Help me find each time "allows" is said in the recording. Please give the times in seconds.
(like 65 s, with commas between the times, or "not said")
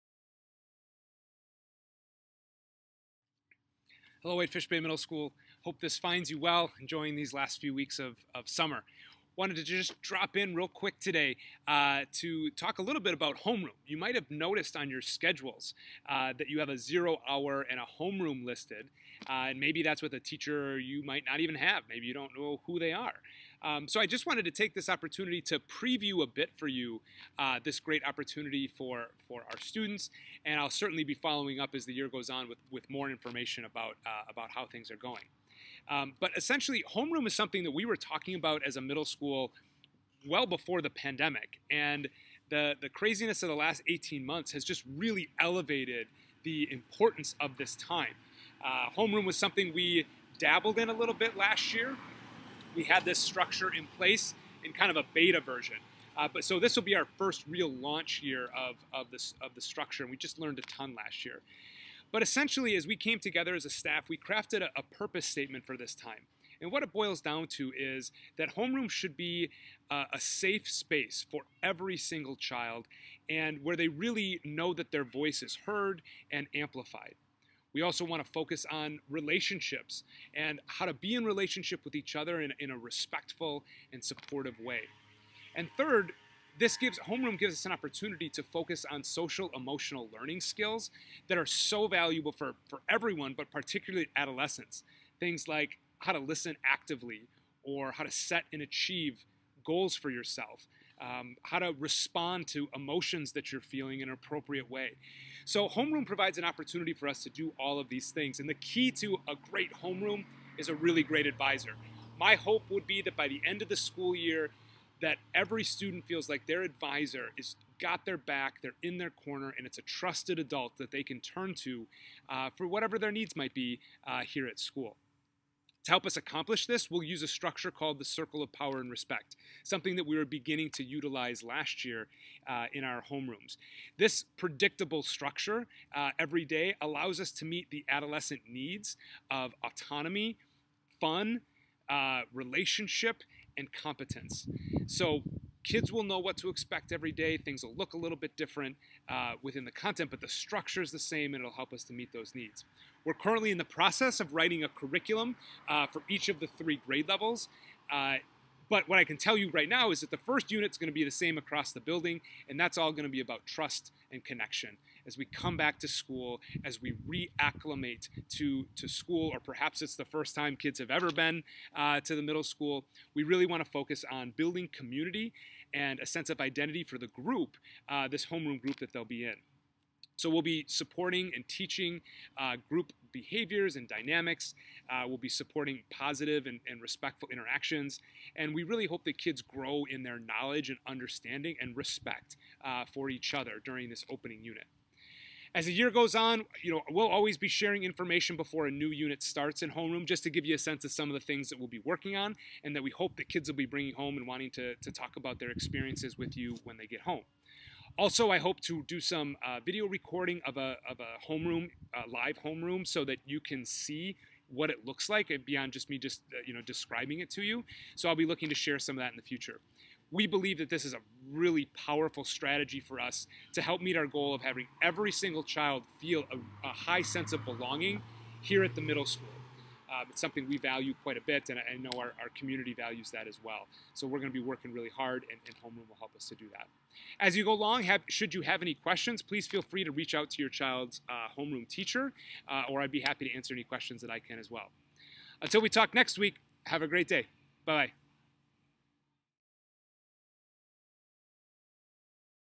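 136 s.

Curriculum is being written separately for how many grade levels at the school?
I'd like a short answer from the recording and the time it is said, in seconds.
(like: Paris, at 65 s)
3, at 156 s.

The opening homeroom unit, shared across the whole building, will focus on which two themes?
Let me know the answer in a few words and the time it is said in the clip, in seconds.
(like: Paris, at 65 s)
Trust and connection, at 163 s.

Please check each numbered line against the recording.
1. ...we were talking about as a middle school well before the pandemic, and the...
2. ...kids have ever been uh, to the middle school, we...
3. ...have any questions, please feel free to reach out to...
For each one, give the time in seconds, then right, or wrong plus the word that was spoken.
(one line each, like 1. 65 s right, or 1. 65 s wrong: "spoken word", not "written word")
1. 37 s right
2. 170 s right
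3. 238 s right.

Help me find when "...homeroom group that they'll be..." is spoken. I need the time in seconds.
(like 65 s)
178 s.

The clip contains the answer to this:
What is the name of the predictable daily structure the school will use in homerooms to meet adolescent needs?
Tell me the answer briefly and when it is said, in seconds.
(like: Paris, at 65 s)
Circle of Power and Respect, at 128 s.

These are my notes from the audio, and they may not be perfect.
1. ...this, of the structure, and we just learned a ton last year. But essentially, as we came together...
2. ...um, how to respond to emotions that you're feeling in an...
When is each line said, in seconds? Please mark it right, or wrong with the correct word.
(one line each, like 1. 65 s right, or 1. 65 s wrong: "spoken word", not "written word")
1. 59 s right
2. 101 s right.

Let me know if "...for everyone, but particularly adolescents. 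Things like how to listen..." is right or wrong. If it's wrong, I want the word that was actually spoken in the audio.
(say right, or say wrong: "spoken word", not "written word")
right.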